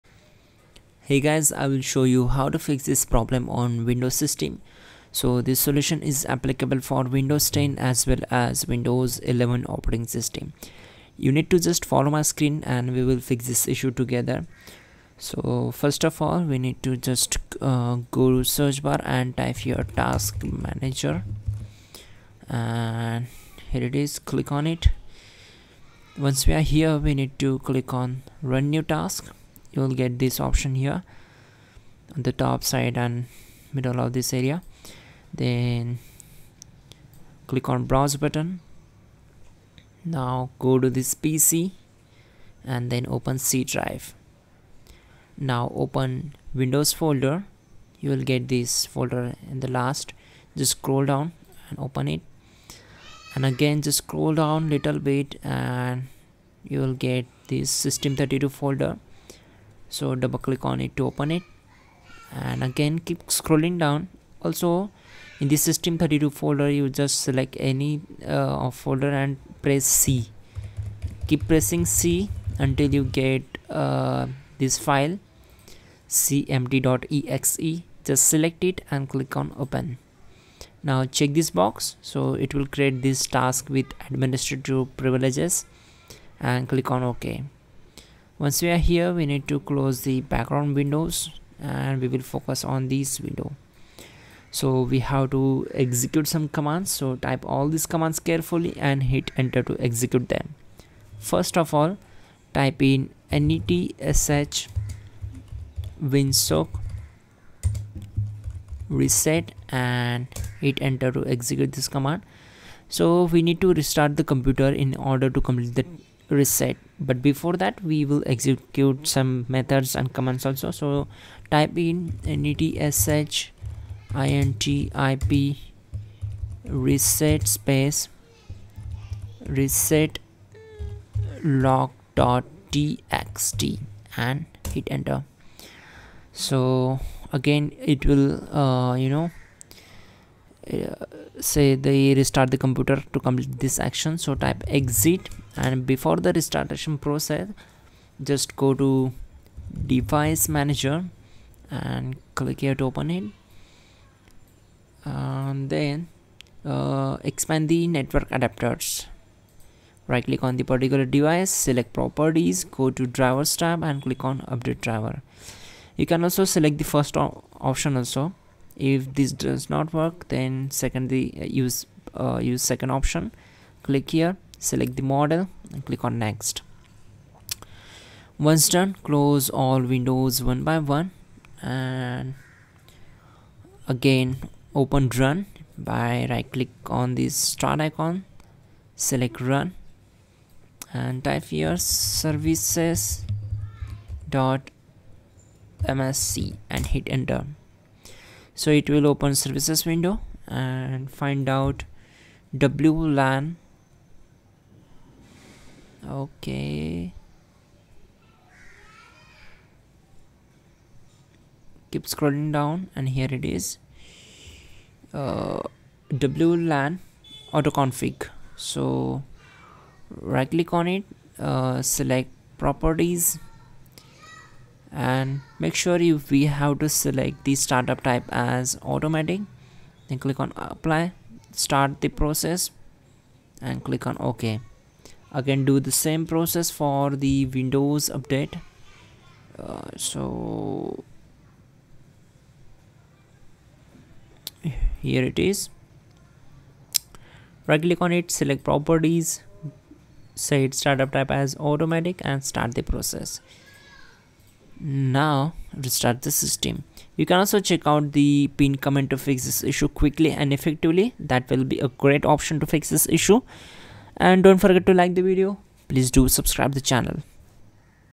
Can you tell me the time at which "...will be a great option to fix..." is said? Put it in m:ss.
4:21.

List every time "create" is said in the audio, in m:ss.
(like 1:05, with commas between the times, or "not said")
1:22.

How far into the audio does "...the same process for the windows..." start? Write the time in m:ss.
3:55.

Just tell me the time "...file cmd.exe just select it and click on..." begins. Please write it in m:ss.
1:14.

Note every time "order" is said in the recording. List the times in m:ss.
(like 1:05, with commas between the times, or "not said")
1:55.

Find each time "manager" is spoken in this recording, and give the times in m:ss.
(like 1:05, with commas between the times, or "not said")
0:20, 2:30.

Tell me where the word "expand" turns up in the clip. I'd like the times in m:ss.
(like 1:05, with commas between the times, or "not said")
2:37.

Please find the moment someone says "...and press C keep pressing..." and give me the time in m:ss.
1:09.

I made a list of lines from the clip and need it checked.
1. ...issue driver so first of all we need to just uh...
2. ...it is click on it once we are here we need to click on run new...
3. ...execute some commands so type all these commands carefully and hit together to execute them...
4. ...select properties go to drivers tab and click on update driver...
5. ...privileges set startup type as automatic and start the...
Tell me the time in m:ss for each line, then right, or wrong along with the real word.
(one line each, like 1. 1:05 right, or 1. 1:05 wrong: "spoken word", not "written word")
1. 0:13 wrong: "together", not "driver"
2. 0:23 right
3. 1:35 wrong: "enter", not "together"
4. 2:41 right
5. 4:08 wrong: "properties", not "privileges".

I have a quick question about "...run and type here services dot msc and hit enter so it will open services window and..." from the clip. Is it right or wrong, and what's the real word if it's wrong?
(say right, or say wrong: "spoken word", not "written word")
right.